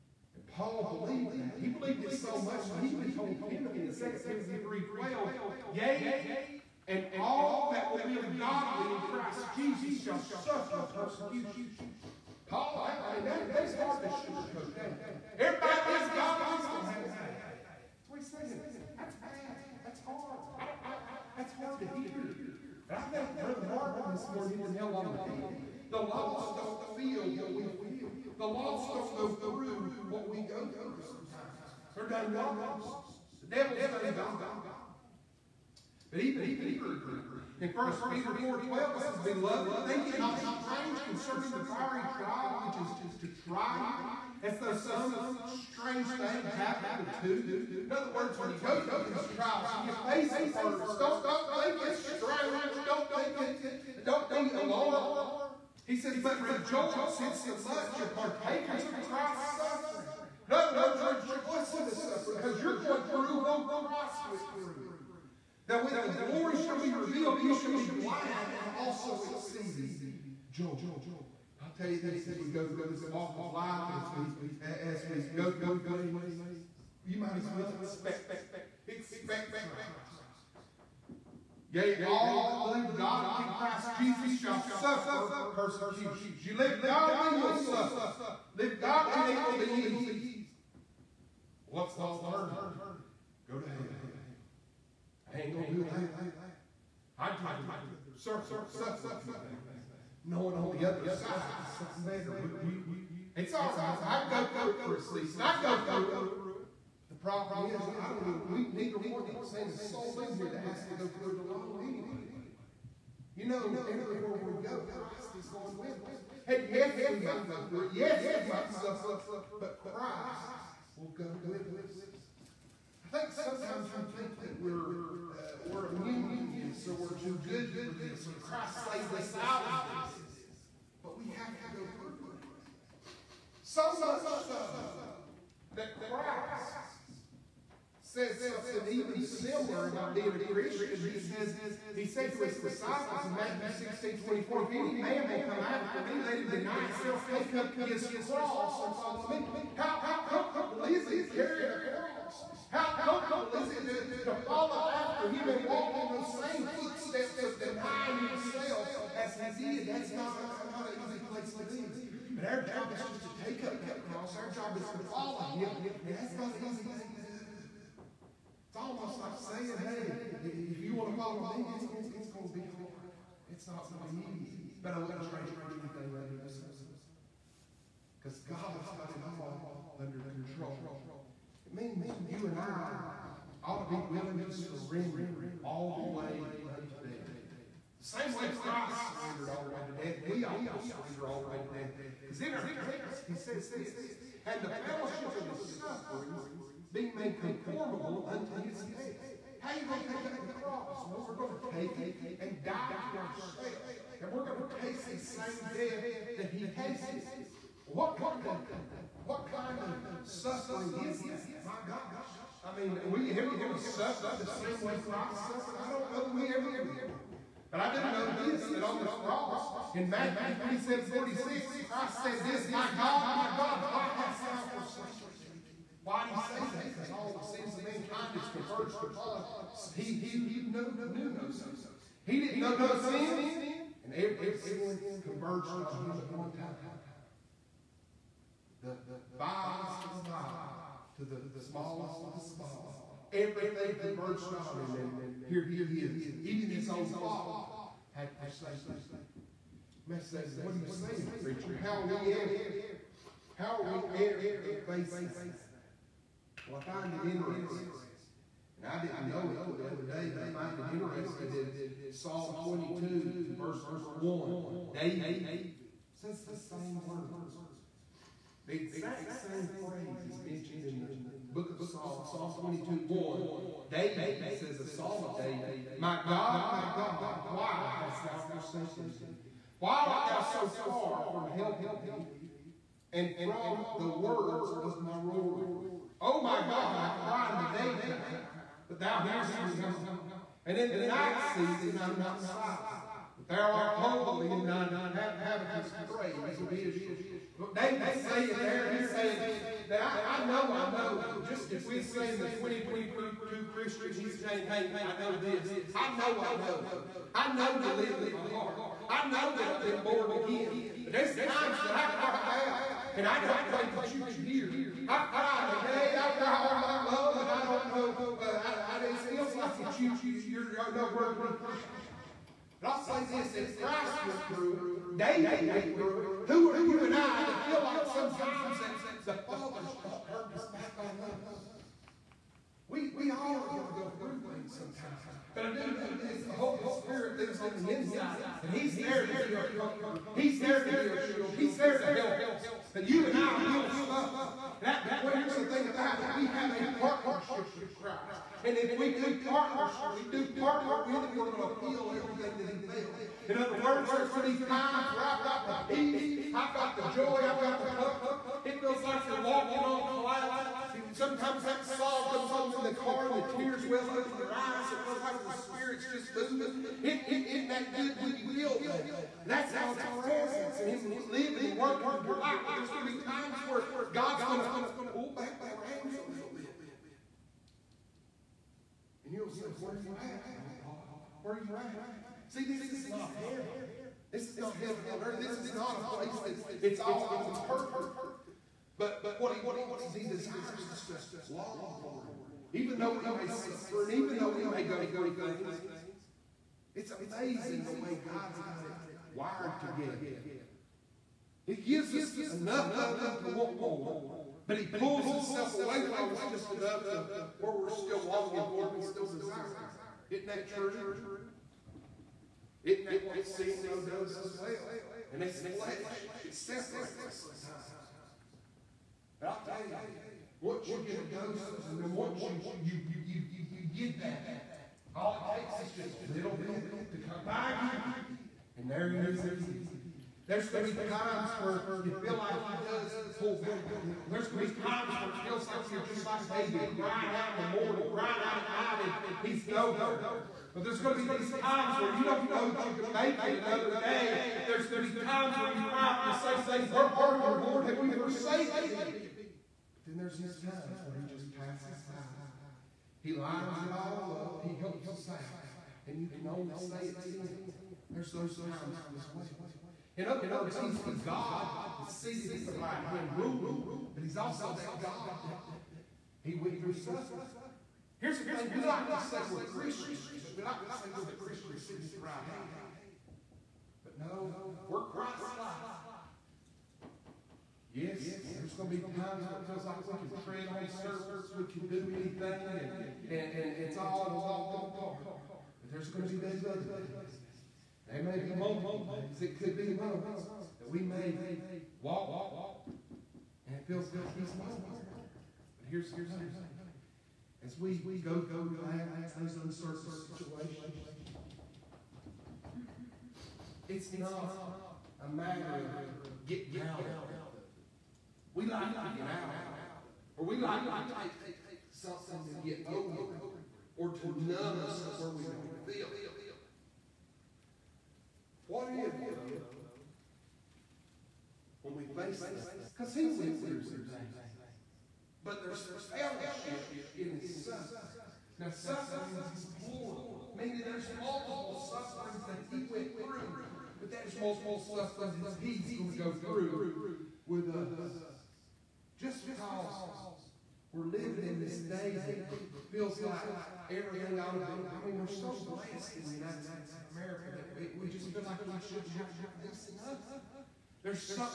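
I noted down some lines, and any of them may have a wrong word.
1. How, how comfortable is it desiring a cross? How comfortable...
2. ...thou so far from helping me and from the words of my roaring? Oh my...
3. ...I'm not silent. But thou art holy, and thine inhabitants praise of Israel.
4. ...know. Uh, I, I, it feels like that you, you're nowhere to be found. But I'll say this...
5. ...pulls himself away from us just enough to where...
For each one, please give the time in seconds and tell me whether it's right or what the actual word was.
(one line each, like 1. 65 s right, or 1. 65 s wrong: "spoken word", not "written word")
1. 149 s wrong: "carrying", not "desiring"
2. 280 s right
3. 292 s right
4. 317 s right
5. 404 s right.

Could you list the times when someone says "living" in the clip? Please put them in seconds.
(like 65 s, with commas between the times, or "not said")
371 s, 541 s.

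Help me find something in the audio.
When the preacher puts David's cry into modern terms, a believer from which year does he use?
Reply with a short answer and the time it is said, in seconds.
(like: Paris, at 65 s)
2022, at 302 s.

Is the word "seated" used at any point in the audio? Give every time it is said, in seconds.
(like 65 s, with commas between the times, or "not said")
462 s, 471 s.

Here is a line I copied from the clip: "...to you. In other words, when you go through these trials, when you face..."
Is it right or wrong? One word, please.
right.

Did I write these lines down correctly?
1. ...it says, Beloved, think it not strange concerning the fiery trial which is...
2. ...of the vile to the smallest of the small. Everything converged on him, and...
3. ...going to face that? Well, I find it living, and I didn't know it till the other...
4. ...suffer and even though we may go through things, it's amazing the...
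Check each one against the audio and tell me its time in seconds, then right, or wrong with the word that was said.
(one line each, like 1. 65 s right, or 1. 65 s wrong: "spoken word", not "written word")
1. 38 s right
2. 240 s right
3. 254 s wrong: "interesting", not "living"
4. 393 s right.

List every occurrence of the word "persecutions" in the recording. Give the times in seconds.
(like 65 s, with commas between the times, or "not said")
10 s, 85 s.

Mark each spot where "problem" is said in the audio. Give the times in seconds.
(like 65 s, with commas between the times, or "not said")
107 s.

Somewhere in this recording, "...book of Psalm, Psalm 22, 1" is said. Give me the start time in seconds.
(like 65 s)
271 s.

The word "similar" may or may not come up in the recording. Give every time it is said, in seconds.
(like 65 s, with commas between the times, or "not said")
139 s.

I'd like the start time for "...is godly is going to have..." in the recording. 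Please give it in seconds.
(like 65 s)
16 s.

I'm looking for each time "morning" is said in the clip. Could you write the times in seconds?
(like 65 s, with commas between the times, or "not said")
24 s, 437 s.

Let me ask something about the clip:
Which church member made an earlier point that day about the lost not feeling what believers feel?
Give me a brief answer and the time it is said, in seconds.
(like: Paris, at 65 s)
Brother Marvin, at 23 s.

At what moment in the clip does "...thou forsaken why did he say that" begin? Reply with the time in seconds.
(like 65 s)
224 s.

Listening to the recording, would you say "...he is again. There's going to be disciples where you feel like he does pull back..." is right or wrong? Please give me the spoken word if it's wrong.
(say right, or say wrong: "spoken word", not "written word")
wrong: "times", not "disciples".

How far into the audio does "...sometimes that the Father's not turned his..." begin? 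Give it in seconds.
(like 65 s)
328 s.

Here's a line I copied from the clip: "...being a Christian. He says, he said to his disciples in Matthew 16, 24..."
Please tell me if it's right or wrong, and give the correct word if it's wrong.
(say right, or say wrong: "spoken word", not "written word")
right.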